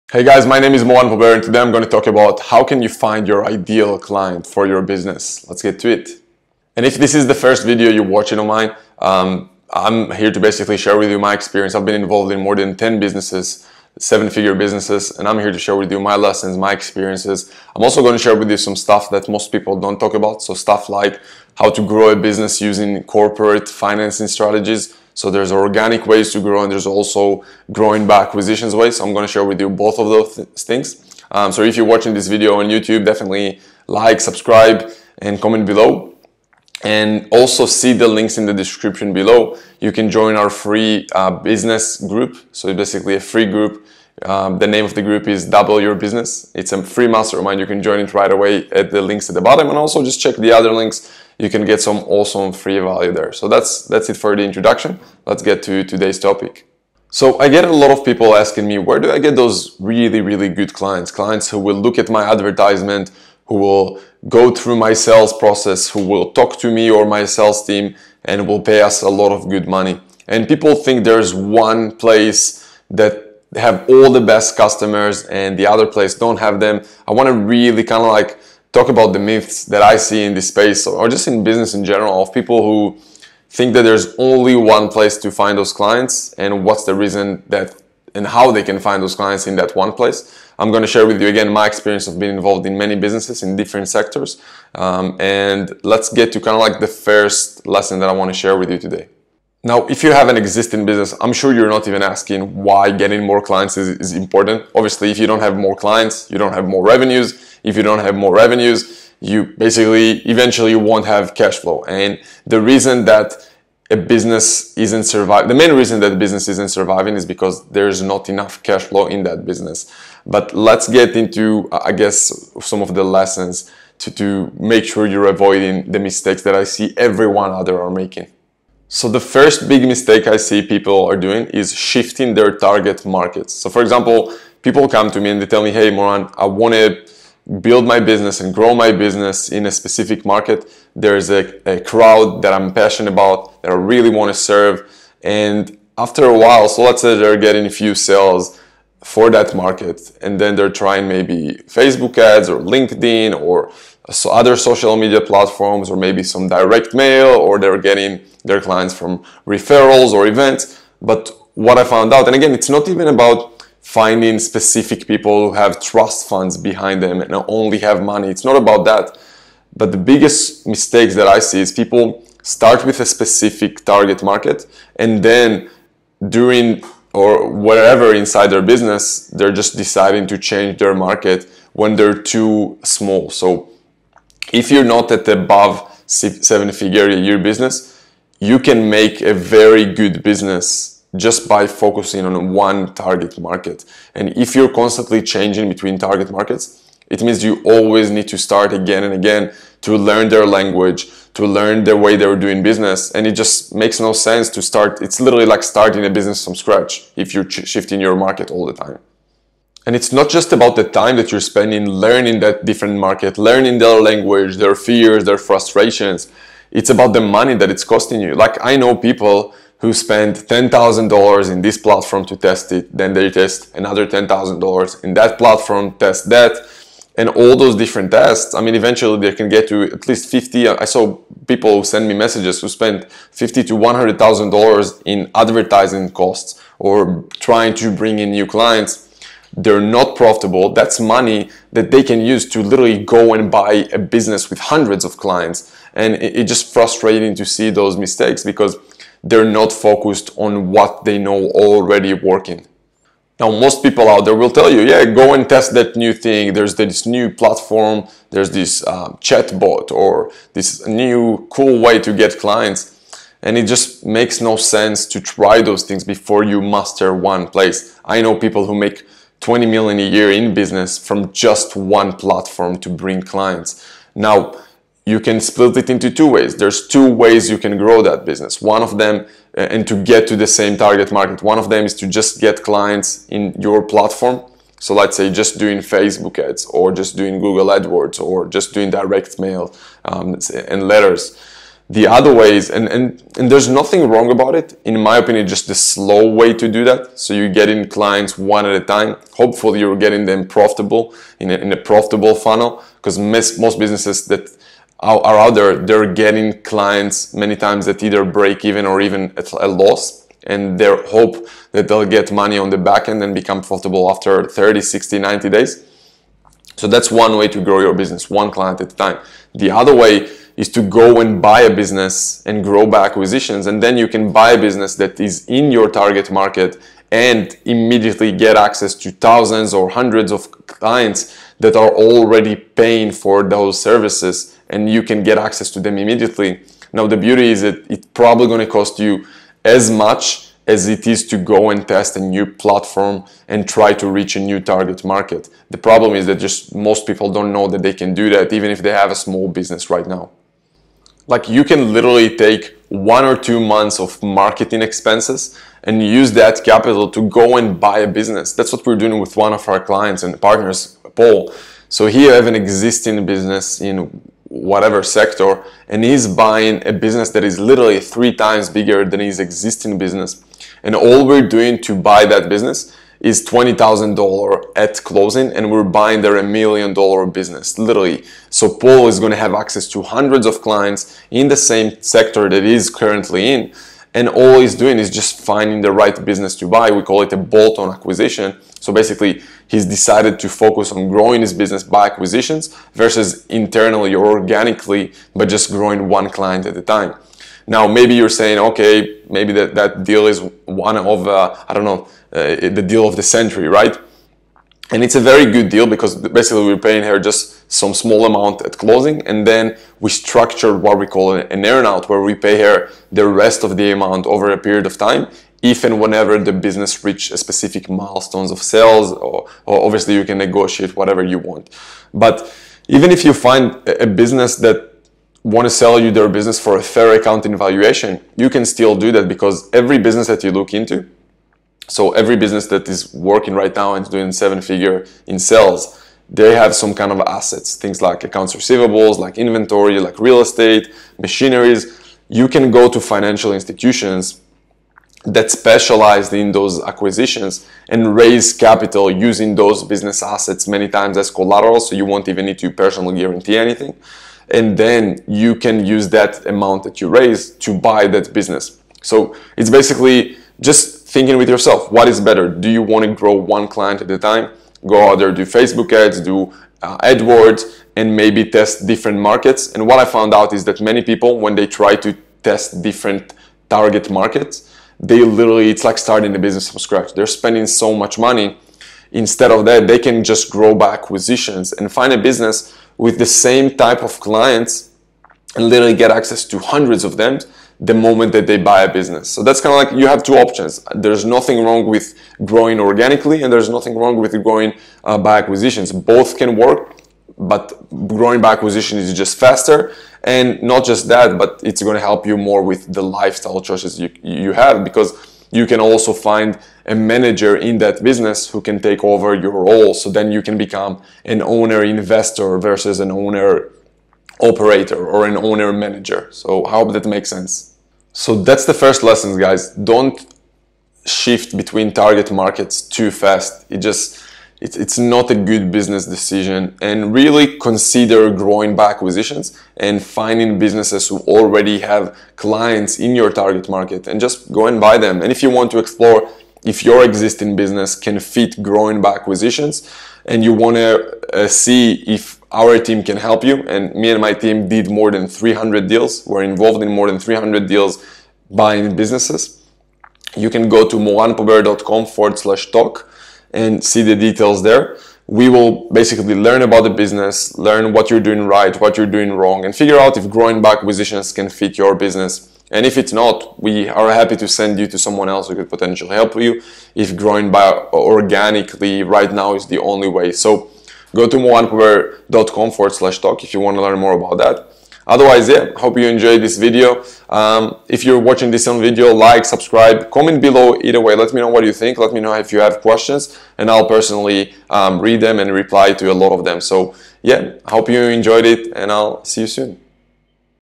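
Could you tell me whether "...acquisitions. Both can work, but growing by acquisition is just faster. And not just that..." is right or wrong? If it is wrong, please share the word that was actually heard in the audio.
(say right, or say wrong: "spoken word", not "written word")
right.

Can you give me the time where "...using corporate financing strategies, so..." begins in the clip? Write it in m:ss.
0:22.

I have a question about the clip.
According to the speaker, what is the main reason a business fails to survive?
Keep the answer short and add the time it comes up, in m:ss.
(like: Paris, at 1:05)
not enough cash flow, at 1:58.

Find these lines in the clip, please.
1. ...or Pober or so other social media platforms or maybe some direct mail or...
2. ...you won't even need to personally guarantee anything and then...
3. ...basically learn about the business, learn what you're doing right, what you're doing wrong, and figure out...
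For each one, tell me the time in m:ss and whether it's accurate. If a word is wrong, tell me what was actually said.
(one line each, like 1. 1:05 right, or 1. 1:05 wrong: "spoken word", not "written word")
1. 2:32 wrong: "LinkedIn", not "Pober"
2. 7:31 right
3. 9:15 right.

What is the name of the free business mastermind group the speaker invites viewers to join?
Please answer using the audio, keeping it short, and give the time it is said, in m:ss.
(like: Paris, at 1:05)
Double Your Business, at 0:45.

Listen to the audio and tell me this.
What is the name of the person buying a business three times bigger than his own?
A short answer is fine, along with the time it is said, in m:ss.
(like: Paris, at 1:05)
Paul, at 6:18.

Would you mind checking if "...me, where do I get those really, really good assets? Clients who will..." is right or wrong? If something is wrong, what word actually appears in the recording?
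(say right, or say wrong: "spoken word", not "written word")
wrong: "clients", not "assets".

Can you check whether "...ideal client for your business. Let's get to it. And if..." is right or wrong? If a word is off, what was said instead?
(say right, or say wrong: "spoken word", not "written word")
right.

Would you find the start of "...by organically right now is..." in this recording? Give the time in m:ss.
9:27.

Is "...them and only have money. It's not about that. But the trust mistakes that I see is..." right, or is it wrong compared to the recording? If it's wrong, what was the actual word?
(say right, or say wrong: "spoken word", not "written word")
wrong: "biggest", not "trust".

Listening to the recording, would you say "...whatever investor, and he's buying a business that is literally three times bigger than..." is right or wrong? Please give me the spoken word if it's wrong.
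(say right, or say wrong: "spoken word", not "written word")
wrong: "sector", not "investor".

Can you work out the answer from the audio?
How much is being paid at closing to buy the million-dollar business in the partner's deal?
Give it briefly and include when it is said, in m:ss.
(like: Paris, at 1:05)
$20,000, at 6:13.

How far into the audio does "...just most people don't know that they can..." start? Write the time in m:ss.
5:46.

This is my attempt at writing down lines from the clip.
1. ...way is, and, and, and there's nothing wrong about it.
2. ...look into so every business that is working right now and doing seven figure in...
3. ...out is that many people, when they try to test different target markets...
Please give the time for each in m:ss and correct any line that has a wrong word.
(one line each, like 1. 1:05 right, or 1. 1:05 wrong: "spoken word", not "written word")
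1. 4:52 right
2. 7:10 right
3. 7:50 right.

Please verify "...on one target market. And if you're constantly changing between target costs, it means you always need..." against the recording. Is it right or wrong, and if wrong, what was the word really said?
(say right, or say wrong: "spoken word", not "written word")
wrong: "markets", not "costs".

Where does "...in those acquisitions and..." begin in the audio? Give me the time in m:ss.
7:26.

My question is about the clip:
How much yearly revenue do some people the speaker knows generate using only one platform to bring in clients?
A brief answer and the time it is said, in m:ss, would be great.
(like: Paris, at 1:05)
20 million, at 4:29.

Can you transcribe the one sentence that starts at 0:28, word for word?
So I'm going to share with you both of those th things.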